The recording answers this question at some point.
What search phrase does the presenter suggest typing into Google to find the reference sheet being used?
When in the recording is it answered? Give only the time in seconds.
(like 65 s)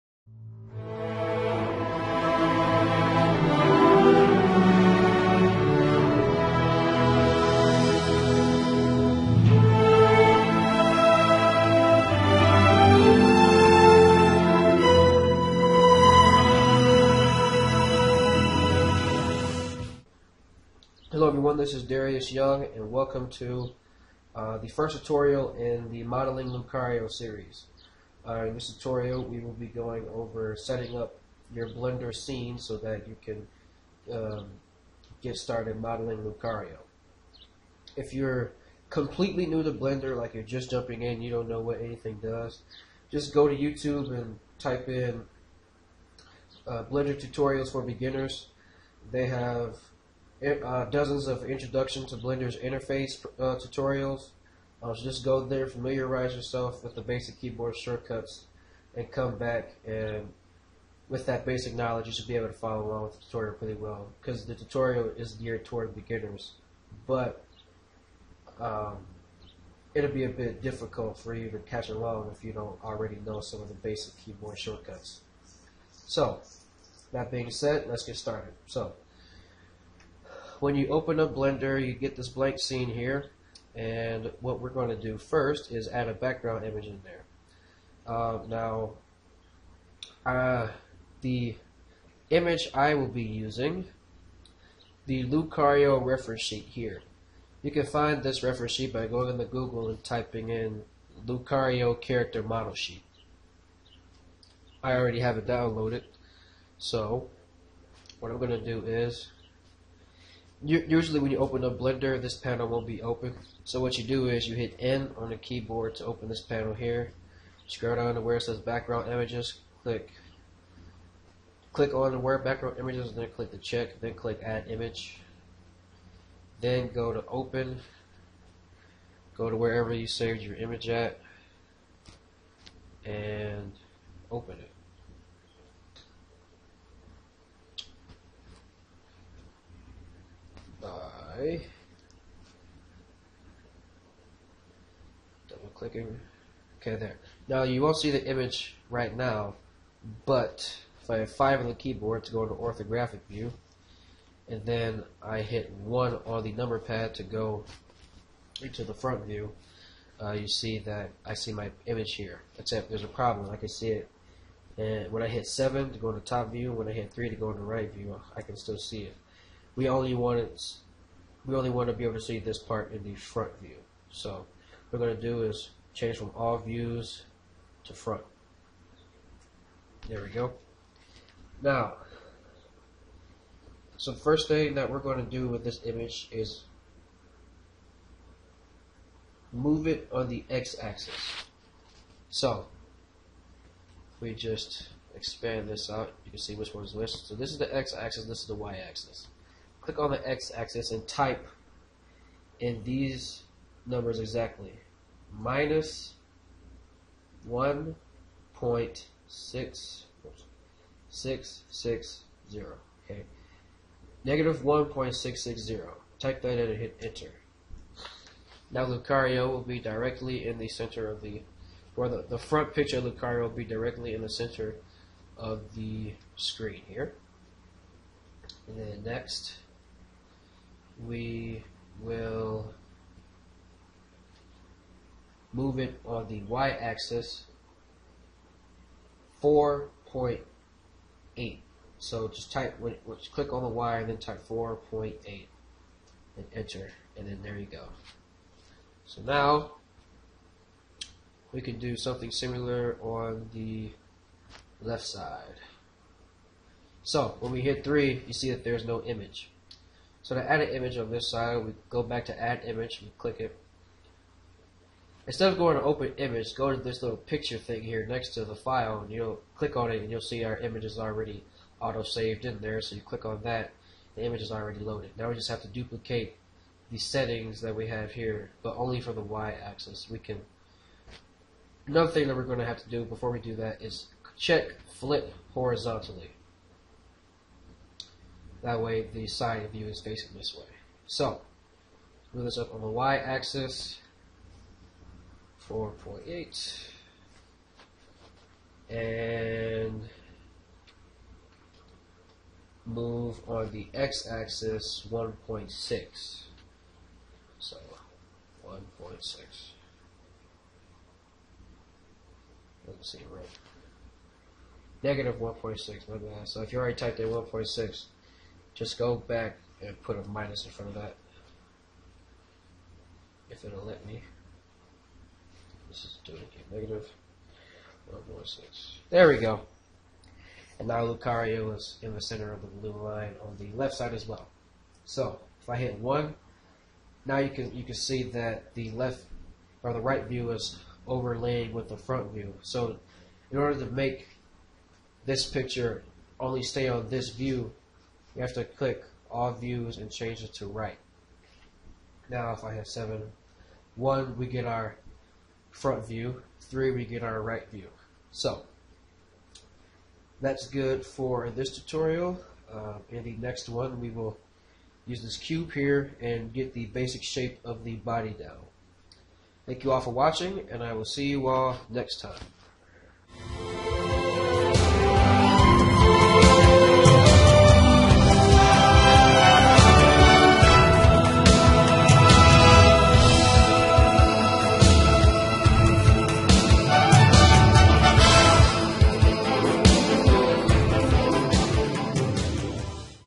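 101 s.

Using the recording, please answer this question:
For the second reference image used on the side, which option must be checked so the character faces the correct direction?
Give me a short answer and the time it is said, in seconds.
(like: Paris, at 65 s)
flip horizontally, at 284 s.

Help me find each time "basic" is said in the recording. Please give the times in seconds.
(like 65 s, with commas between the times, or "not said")
57 s, 61 s, 73 s, 366 s.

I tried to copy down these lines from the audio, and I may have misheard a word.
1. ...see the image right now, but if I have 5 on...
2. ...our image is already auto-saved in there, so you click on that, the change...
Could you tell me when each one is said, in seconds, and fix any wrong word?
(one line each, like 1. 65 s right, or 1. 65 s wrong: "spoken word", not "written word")
1. 147 s right
2. 270 s wrong: "image", not "change".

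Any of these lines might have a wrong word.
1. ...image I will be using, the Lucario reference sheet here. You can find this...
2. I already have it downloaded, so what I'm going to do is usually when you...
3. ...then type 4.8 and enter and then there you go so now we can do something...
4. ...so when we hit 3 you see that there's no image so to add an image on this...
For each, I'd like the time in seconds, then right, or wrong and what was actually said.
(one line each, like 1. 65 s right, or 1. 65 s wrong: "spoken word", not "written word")
1. 92 s right
2. 104 s right
3. 244 s right
4. 257 s right.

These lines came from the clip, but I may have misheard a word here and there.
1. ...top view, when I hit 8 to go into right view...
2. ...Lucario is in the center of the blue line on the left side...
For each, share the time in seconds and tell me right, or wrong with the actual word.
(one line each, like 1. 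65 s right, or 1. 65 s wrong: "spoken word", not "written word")
1. 166 s wrong: "3", not "8"
2. 331 s right.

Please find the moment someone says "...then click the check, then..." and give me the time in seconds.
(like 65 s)
123 s.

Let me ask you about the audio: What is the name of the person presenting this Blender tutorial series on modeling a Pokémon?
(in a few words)
Darius Young.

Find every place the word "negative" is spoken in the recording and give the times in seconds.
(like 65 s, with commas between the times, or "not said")
214 s, 315 s, 326 s.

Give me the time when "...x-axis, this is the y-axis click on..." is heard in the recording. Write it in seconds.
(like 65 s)
197 s.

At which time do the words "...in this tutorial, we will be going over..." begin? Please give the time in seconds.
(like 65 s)
28 s.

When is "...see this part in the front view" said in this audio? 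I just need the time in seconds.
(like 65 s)
172 s.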